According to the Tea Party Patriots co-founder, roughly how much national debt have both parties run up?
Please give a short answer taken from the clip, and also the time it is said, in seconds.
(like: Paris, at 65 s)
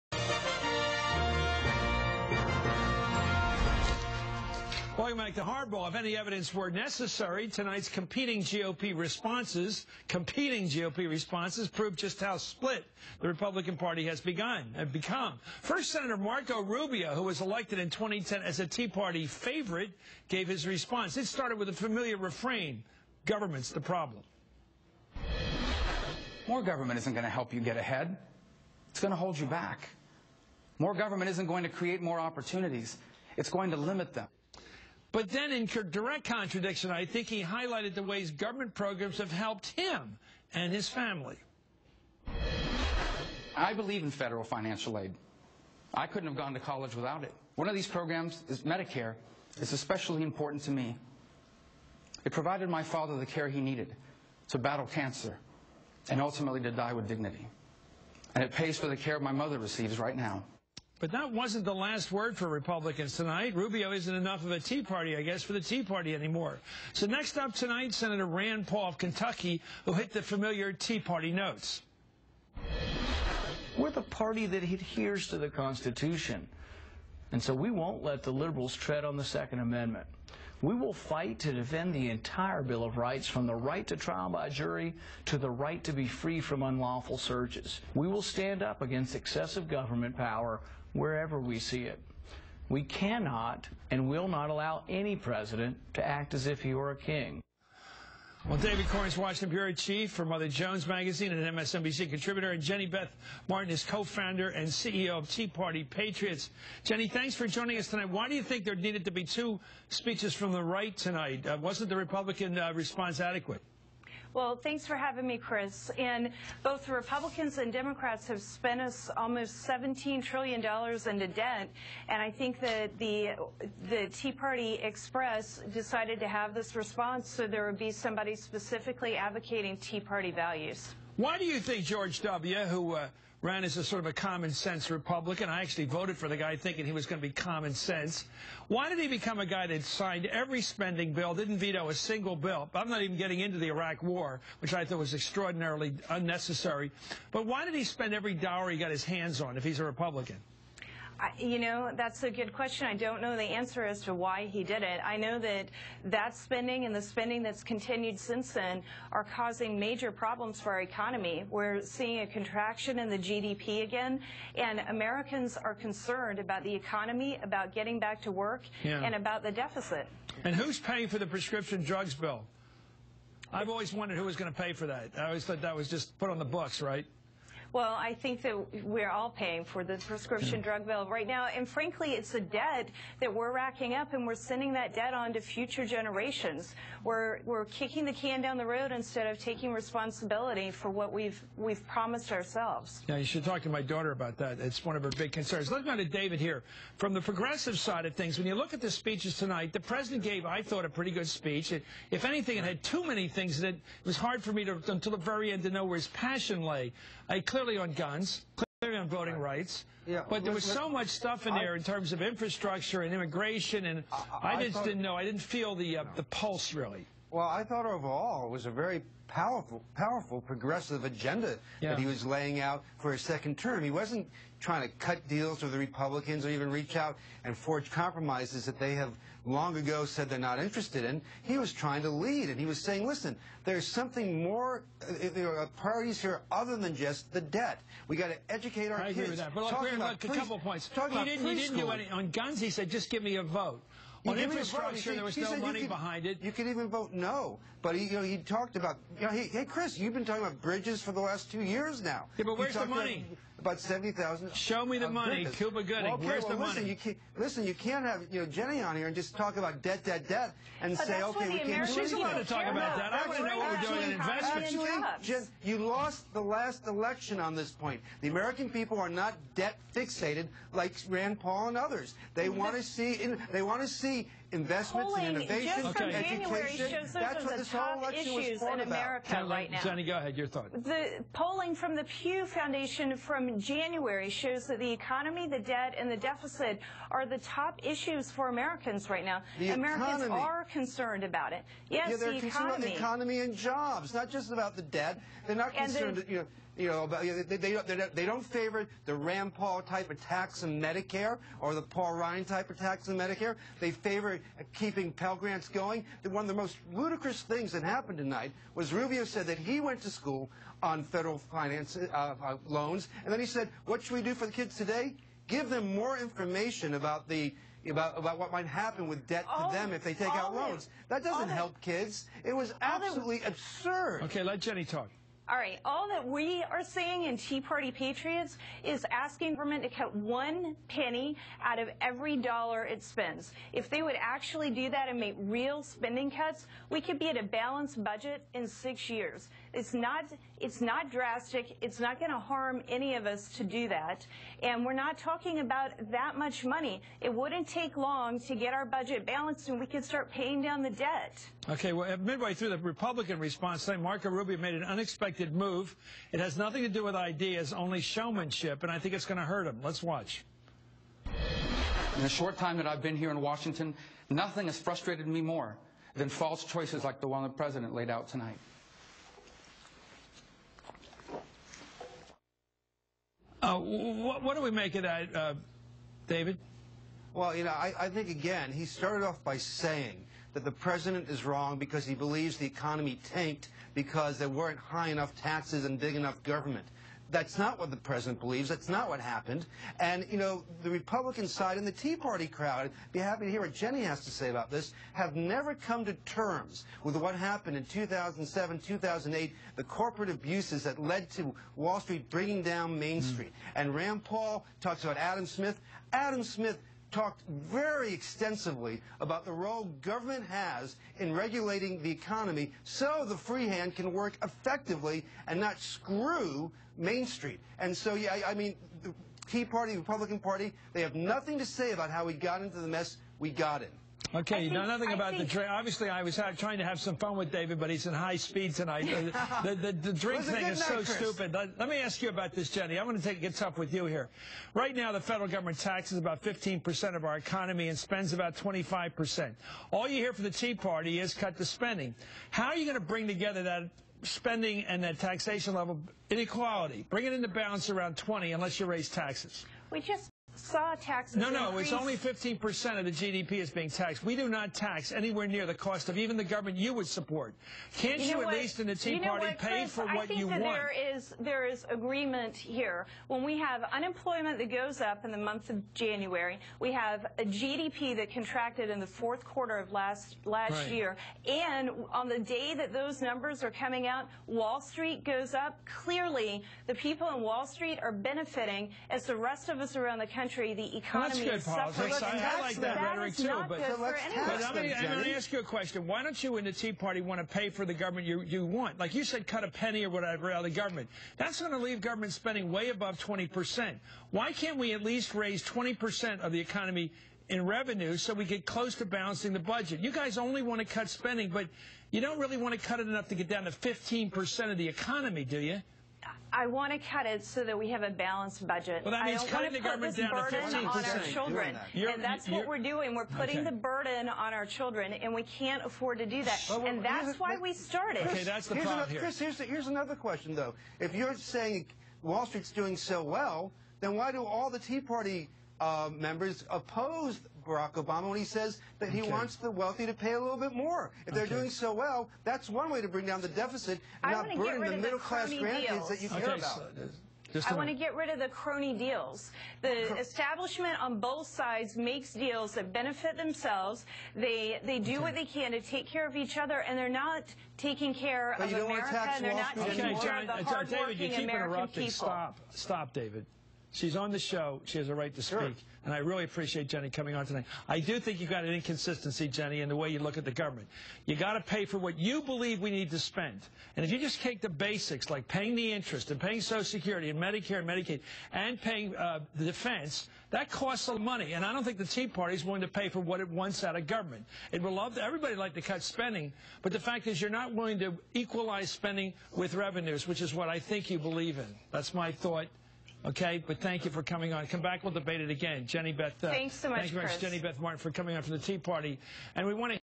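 almost $17 trillion, at 119 s.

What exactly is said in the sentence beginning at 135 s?
I actually voted for the guy thinking he was going to be common sense.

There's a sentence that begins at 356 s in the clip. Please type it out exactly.
It has nothing to do with ideas, only showmanship, and I think it's going to hurt him.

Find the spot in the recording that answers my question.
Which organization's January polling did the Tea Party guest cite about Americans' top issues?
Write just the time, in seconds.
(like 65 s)
282 s.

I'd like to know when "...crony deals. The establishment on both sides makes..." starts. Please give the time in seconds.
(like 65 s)
538 s.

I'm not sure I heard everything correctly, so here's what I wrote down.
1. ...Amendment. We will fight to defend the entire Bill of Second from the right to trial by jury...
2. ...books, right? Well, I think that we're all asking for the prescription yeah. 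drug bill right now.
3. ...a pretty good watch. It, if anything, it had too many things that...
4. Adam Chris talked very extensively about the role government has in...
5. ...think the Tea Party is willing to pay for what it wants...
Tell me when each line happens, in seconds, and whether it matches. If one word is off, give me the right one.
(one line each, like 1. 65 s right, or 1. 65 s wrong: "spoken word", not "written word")
1. 79 s wrong: "Rights", not "Second"
2. 176 s wrong: "paying", not "asking"
3. 200 s wrong: "speech", not "watch"
4. 406 s wrong: "Smith", not "Chris"
5. 571 s right.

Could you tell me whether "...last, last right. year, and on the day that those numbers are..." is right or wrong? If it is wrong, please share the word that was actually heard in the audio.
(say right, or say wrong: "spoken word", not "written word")
right.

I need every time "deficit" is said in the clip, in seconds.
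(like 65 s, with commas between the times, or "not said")
169 s, 286 s, 533 s.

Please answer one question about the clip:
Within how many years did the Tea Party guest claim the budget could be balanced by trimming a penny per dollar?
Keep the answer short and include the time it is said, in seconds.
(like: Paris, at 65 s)
6, at 338 s.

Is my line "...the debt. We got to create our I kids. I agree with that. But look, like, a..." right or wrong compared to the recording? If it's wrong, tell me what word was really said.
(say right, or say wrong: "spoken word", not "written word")
wrong: "educate", not "create".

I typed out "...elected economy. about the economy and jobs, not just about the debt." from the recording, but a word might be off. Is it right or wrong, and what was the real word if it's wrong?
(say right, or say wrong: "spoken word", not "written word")
wrong: "concerned", not "elected".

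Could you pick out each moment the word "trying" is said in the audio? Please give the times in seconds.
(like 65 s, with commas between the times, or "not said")
224 s, 231 s, 426 s.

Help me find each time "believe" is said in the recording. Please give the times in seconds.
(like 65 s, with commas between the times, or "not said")
43 s, 382 s, 388 s, 562 s, 581 s.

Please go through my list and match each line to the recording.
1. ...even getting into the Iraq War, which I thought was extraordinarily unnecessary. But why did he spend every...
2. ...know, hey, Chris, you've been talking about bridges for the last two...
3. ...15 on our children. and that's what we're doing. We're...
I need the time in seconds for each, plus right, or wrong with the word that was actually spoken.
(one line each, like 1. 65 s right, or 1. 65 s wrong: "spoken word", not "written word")
1. 143 s right
2. 249 s right
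3. 510 s right.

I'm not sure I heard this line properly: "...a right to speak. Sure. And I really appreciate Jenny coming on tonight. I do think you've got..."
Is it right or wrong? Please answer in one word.
right.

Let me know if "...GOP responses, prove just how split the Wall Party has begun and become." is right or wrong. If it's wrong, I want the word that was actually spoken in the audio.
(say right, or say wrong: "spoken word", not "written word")
wrong: "Republican", not "Wall".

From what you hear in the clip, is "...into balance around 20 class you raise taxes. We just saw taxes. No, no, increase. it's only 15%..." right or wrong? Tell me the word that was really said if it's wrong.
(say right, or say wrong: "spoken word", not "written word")
wrong: "unless", not "class".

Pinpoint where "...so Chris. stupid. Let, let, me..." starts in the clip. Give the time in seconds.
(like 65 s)
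430 s.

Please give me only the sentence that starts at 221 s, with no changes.
that he was laying out for his second term.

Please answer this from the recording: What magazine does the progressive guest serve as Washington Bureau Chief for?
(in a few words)
Mother Jones.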